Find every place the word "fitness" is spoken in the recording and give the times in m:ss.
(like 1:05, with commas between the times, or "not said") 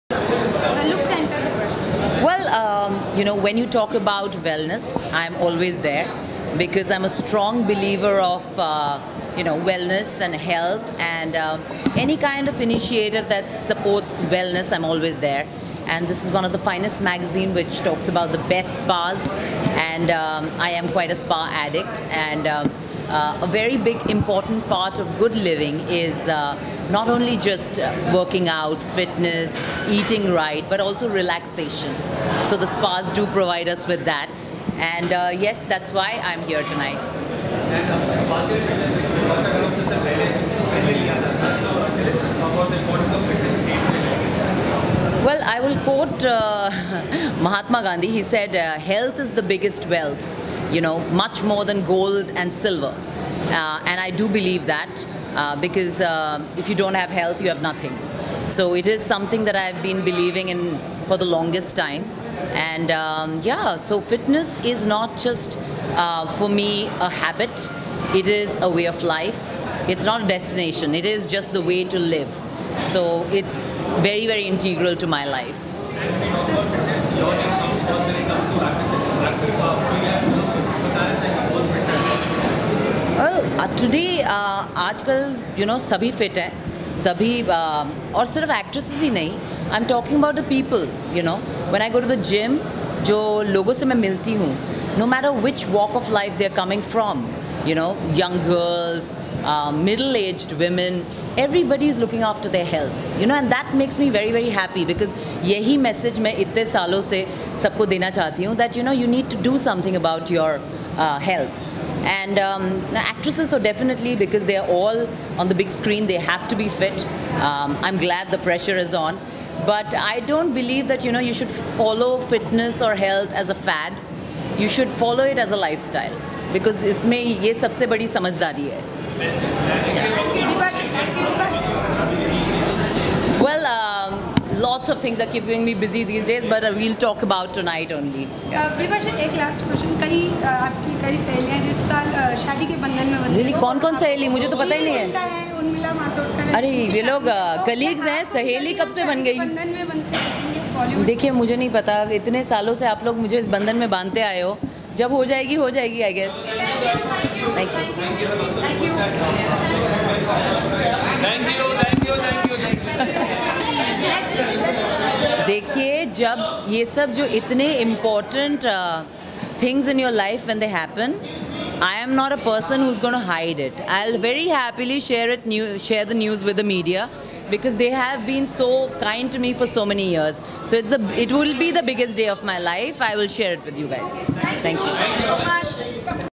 0:28, 1:04, 2:02.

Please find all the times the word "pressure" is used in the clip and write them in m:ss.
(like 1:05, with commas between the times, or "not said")
1:58.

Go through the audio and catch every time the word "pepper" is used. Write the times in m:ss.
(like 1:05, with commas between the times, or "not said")
not said.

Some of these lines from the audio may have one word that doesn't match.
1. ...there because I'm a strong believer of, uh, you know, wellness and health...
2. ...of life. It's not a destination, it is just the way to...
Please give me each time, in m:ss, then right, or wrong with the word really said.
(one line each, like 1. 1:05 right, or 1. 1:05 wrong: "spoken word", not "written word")
1. 0:05 right
2. 1:08 right.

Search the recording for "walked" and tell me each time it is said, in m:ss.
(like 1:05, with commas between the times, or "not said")
not said.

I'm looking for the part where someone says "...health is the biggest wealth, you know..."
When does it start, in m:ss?
0:48.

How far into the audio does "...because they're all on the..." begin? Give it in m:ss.
1:54.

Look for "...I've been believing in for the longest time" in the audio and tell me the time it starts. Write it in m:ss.
0:59.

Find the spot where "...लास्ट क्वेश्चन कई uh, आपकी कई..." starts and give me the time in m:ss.
2:19.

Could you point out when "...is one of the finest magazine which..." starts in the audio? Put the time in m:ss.
0:16.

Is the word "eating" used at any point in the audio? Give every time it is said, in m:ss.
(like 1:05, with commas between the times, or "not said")
0:29.